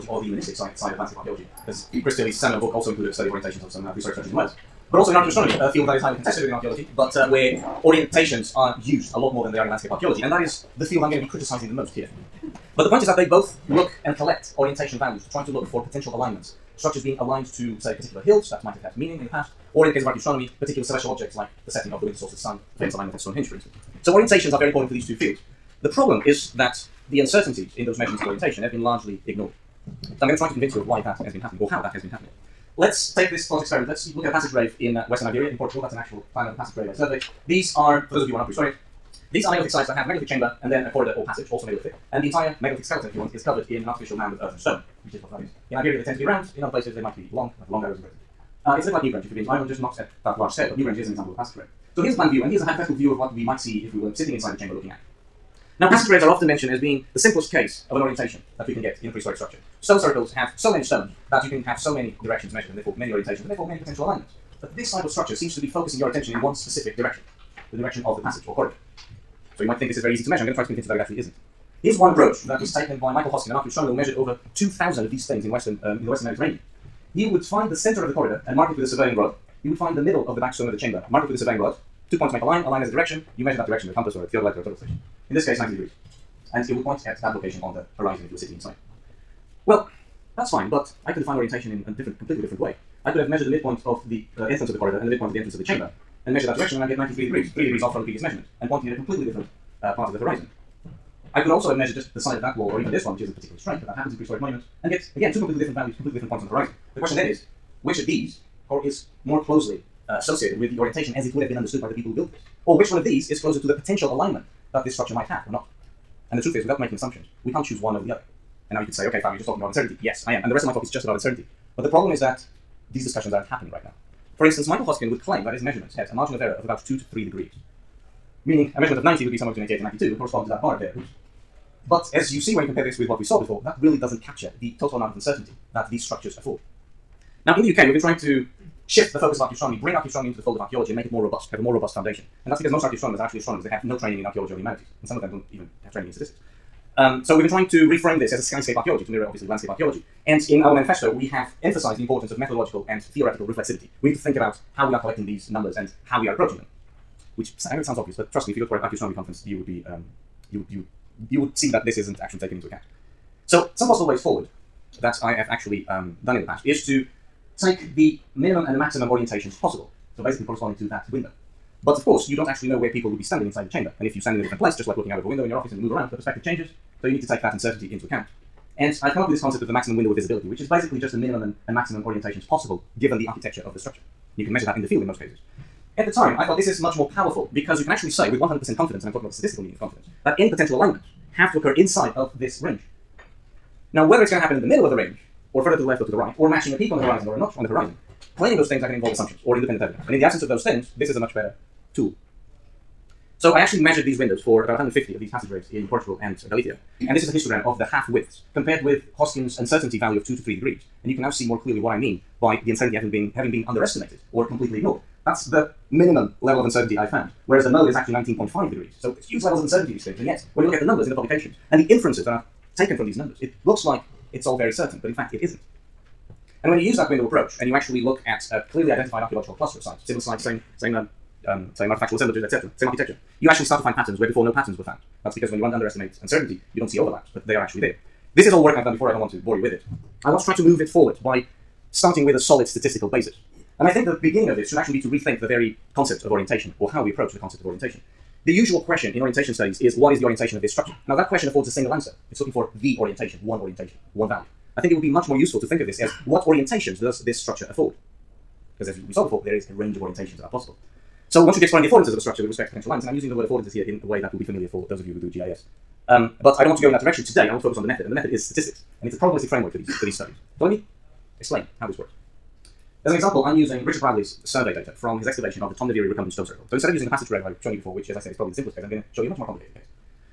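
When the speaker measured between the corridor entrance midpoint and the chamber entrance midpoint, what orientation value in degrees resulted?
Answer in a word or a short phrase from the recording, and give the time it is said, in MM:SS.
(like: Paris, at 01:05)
93 degrees, at 01:36.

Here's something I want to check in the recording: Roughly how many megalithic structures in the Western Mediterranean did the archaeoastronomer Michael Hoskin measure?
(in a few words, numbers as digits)
over 2,000.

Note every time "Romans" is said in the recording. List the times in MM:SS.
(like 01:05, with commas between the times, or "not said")
not said.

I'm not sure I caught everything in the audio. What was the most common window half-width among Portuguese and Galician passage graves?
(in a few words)
19.5 degrees.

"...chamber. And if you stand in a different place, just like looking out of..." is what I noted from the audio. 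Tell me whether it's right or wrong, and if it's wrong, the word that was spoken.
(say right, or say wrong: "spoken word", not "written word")
right.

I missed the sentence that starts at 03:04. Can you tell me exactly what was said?
you can measure that in the field in most cases.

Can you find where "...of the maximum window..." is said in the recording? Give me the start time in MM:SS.
02:59.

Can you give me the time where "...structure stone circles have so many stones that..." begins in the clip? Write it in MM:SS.
00:59.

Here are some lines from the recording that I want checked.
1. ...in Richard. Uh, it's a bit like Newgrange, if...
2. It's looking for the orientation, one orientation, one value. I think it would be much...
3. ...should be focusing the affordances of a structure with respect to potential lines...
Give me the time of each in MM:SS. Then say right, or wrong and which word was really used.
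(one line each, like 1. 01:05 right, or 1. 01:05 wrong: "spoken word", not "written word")
1. 00:47 wrong: "Britain", not "Richard"
2. 04:12 right
3. 04:21 wrong: "exploring", not "focusing".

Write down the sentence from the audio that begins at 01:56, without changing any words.
And the truth is, without making assumptions, we can't choose one over the other.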